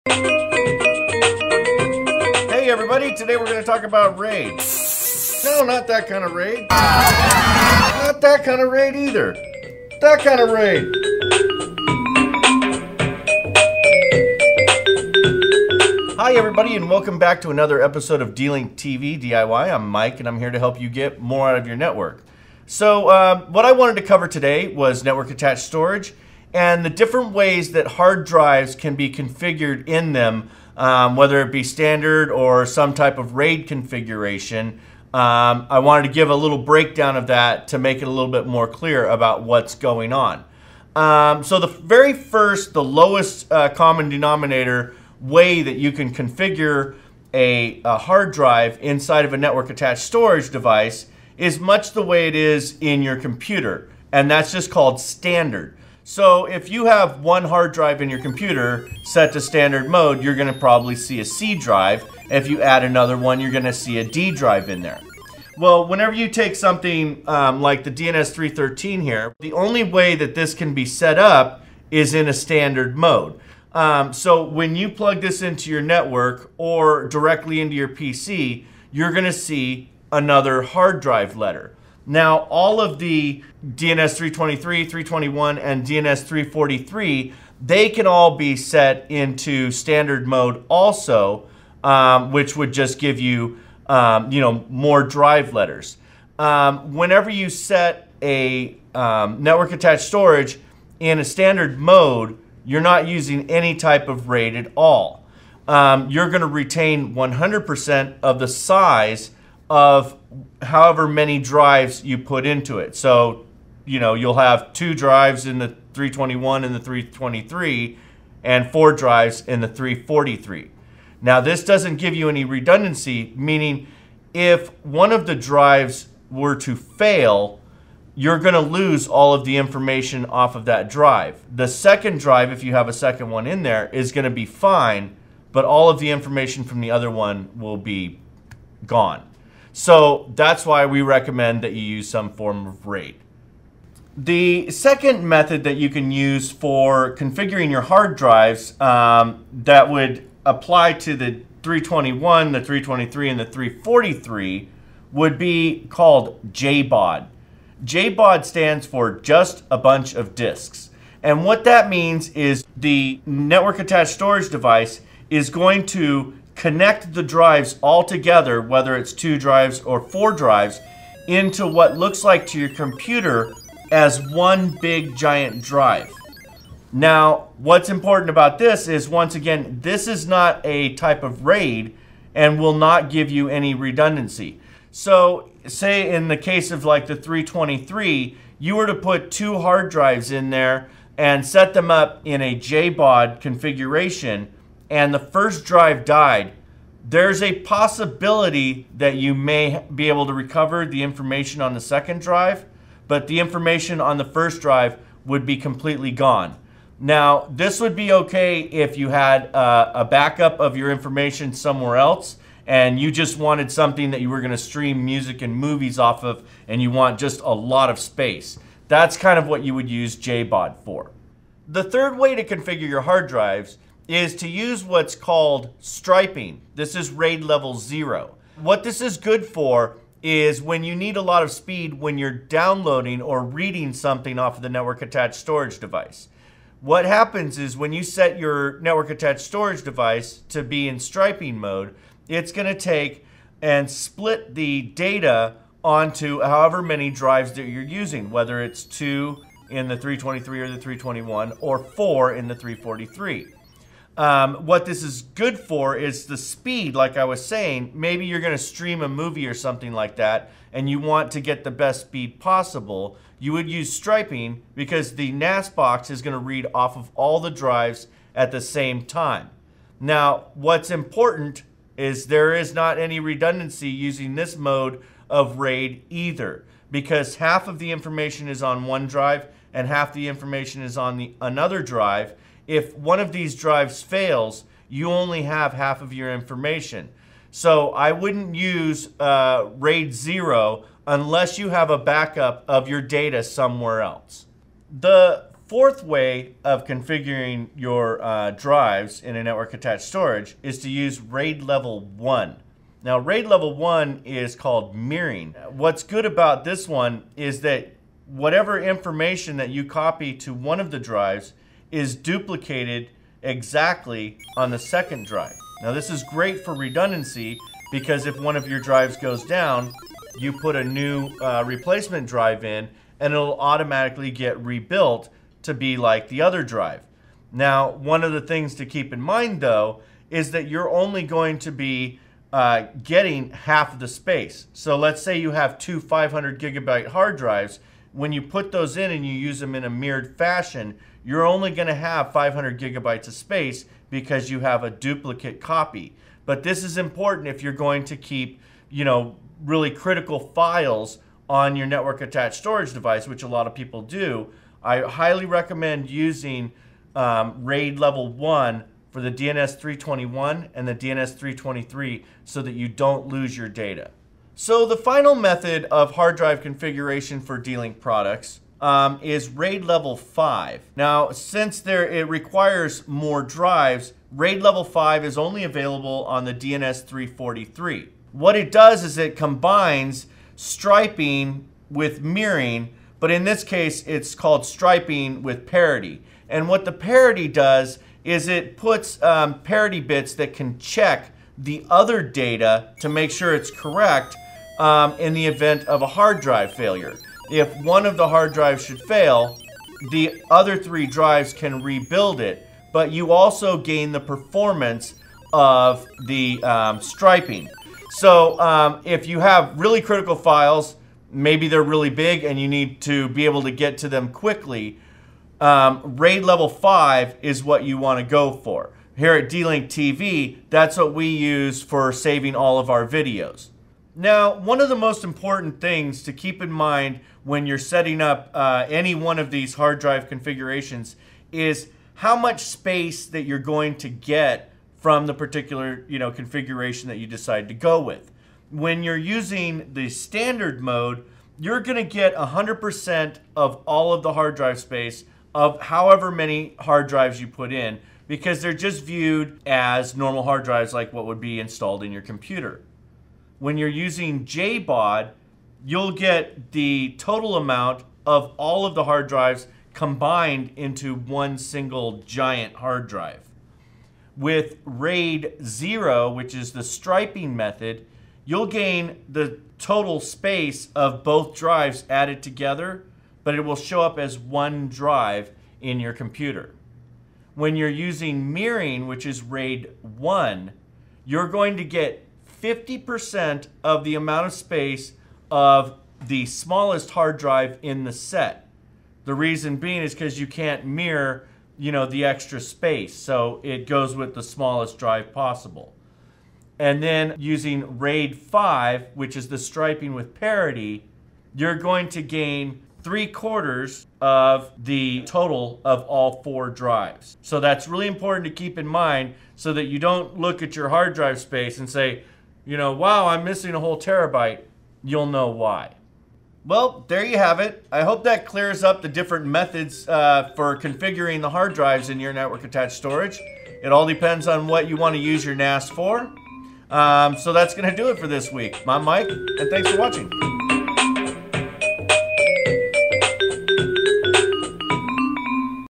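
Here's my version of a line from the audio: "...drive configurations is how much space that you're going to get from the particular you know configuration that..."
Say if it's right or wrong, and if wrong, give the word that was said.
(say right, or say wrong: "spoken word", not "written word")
right.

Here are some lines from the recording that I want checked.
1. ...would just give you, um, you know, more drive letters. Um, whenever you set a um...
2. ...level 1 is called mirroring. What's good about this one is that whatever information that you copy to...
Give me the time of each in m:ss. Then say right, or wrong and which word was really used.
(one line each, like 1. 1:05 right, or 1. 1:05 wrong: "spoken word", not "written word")
1. 1:32 right
2. 5:03 right.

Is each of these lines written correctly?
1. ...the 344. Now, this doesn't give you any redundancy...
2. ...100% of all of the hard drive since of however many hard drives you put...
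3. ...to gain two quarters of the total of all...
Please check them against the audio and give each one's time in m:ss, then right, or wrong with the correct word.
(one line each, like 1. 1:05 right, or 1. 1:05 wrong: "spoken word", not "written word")
1. 1:59 wrong: "343", not "344"
2. 7:22 wrong: "space", not "since"
3. 8:22 wrong: "three", not "two".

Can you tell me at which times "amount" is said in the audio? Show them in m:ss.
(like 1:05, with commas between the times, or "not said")
7:37, 8:04.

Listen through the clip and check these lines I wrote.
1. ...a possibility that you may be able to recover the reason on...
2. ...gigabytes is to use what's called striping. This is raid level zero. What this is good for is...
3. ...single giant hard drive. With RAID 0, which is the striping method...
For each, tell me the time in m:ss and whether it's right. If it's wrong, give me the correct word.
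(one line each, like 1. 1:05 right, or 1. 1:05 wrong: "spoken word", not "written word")
1. 3:17 wrong: "information", not "reason"
2. 3:43 wrong: "drives", not "gigabytes"
3. 7:41 right.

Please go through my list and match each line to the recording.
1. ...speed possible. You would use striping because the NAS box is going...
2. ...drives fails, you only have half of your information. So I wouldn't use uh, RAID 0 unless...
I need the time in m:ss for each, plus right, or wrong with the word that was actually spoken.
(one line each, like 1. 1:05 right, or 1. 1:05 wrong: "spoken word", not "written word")
1. 4:22 right
2. 4:43 right.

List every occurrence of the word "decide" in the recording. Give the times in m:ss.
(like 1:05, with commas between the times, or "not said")
7:17.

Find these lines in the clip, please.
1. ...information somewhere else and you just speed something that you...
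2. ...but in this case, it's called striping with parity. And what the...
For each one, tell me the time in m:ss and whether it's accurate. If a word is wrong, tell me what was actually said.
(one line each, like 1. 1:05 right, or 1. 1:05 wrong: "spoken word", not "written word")
1. 3:30 wrong: "wanted", not "speed"
2. 6:23 right.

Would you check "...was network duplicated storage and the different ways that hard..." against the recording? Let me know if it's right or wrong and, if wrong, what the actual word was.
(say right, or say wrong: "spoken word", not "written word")
wrong: "attached", not "duplicated".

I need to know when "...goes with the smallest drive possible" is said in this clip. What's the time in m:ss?
8:13.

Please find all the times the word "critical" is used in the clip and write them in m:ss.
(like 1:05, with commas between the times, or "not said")
5:49, 6:50.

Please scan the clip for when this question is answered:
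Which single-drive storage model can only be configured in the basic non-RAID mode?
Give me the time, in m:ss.
1:07.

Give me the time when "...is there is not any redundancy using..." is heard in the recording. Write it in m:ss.
4:31.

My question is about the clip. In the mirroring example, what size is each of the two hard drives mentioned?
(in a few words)
500 gigabytes.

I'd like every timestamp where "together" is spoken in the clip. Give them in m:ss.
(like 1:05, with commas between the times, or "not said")
2:48, 7:52.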